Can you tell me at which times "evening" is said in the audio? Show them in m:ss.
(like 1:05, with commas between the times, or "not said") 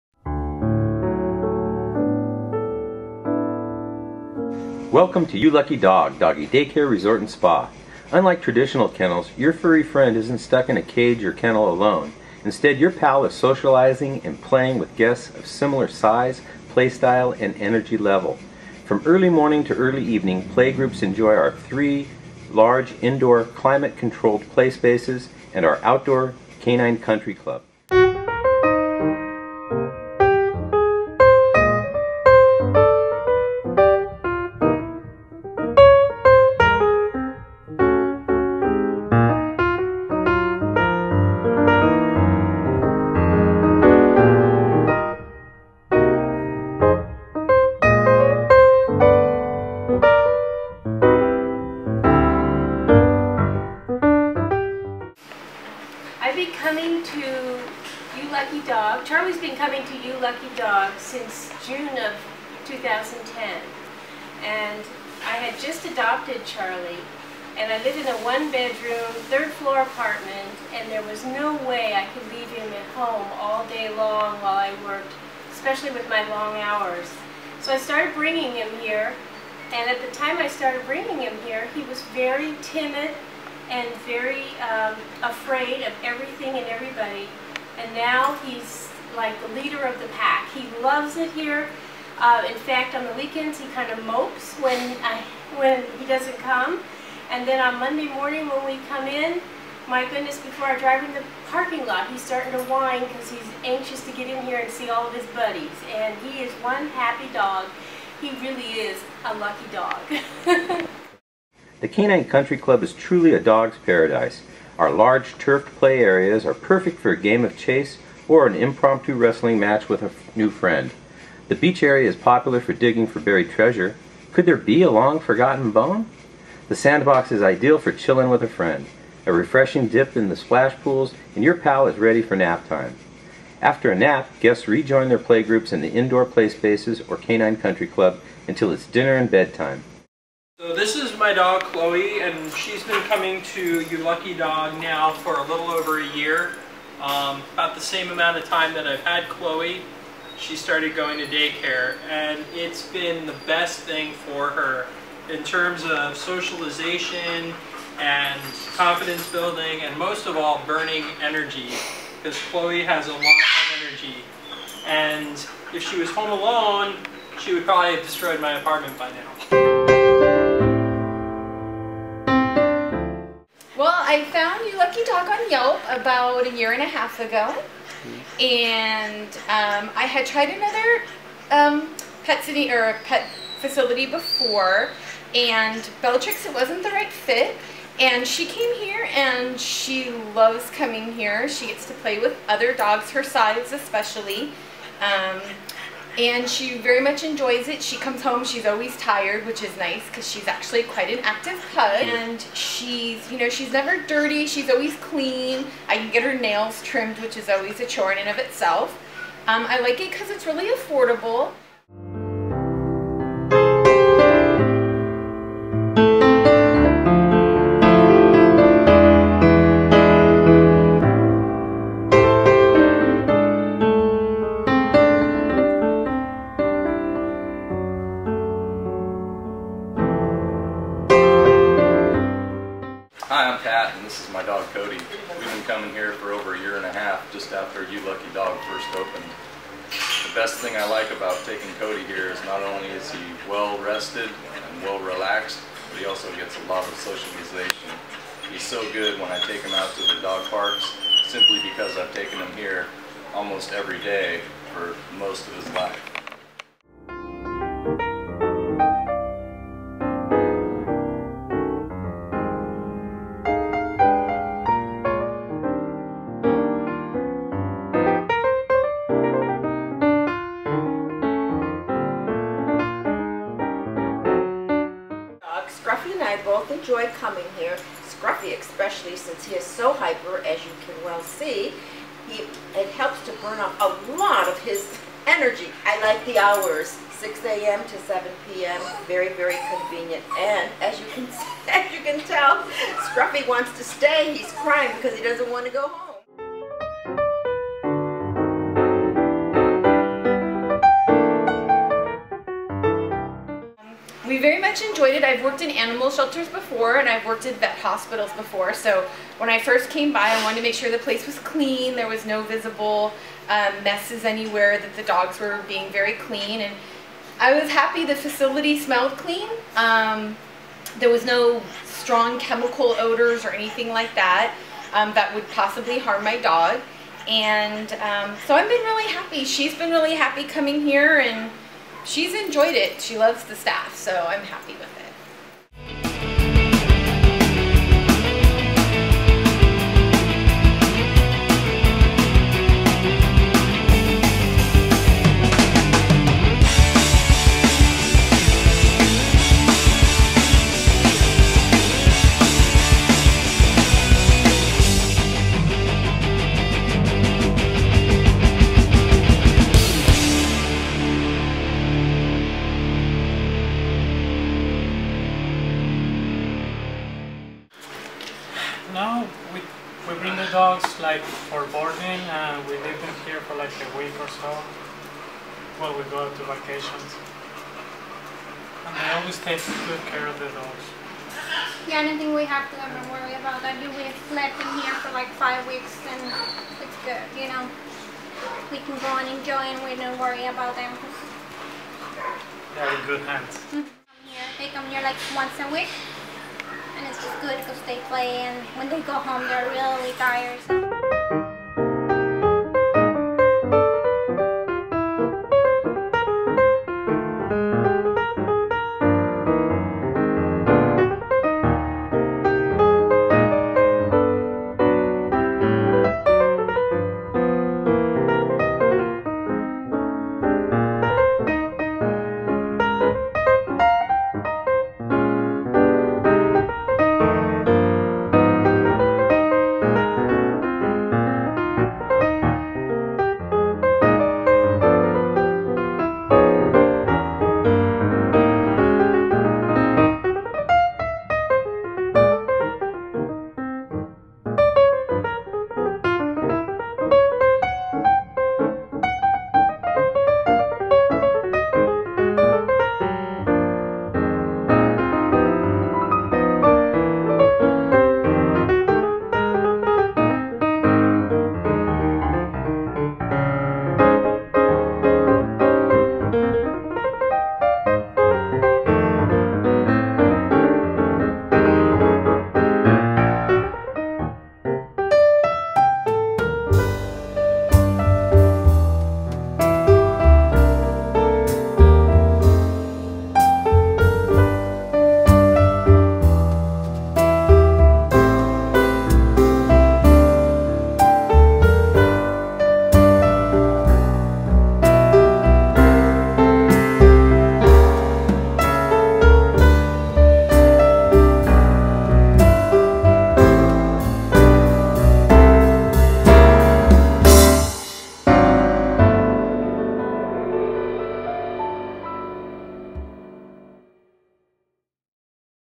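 0:20.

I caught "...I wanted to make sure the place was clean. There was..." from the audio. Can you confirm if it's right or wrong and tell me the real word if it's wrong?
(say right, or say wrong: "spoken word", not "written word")
right.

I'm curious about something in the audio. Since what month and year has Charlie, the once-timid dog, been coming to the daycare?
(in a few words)
June 2010.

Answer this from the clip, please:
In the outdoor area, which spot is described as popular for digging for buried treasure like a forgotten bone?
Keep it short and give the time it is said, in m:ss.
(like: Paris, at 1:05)
The beach area, at 2:01.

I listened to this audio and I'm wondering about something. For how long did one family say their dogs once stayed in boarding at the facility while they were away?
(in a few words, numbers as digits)
5 weeks.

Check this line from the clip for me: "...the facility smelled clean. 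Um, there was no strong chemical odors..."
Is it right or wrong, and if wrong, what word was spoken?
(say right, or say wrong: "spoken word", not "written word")
right.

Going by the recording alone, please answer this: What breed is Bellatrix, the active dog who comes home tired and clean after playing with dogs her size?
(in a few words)
Pug.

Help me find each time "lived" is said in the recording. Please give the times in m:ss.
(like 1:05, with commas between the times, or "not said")
1:07, 6:12.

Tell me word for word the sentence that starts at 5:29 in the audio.
She's been really happy coming here and she's enjoyed it.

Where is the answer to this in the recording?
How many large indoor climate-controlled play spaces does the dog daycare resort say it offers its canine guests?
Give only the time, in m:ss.
0:21.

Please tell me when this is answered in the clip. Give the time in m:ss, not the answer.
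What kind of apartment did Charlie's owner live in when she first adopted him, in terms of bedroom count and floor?
1:08.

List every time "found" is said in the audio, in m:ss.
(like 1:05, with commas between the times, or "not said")
2:54.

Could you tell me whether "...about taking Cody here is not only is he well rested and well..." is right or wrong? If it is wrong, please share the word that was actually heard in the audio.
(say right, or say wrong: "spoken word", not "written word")
right.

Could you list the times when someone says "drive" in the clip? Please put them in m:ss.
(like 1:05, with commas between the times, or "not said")
1:40.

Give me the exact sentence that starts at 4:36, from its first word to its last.
and I both enjoy coming here, Scruffy especially since he is so hyper, as you can well see.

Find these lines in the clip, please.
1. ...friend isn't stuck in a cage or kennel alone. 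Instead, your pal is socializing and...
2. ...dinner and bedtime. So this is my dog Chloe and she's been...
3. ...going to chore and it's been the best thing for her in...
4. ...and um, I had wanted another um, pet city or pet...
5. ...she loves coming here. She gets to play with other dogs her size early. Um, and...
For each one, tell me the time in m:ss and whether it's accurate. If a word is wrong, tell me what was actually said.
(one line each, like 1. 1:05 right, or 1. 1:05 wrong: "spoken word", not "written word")
1. 0:09 right
2. 2:18 right
3. 2:30 wrong: "daycare", not "chore"
4. 2:58 wrong: "tried", not "wanted"
5. 3:09 wrong: "especially", not "early".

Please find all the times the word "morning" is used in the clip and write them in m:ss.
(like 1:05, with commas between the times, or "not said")
0:19, 1:38.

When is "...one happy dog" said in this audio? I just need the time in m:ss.
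1:46.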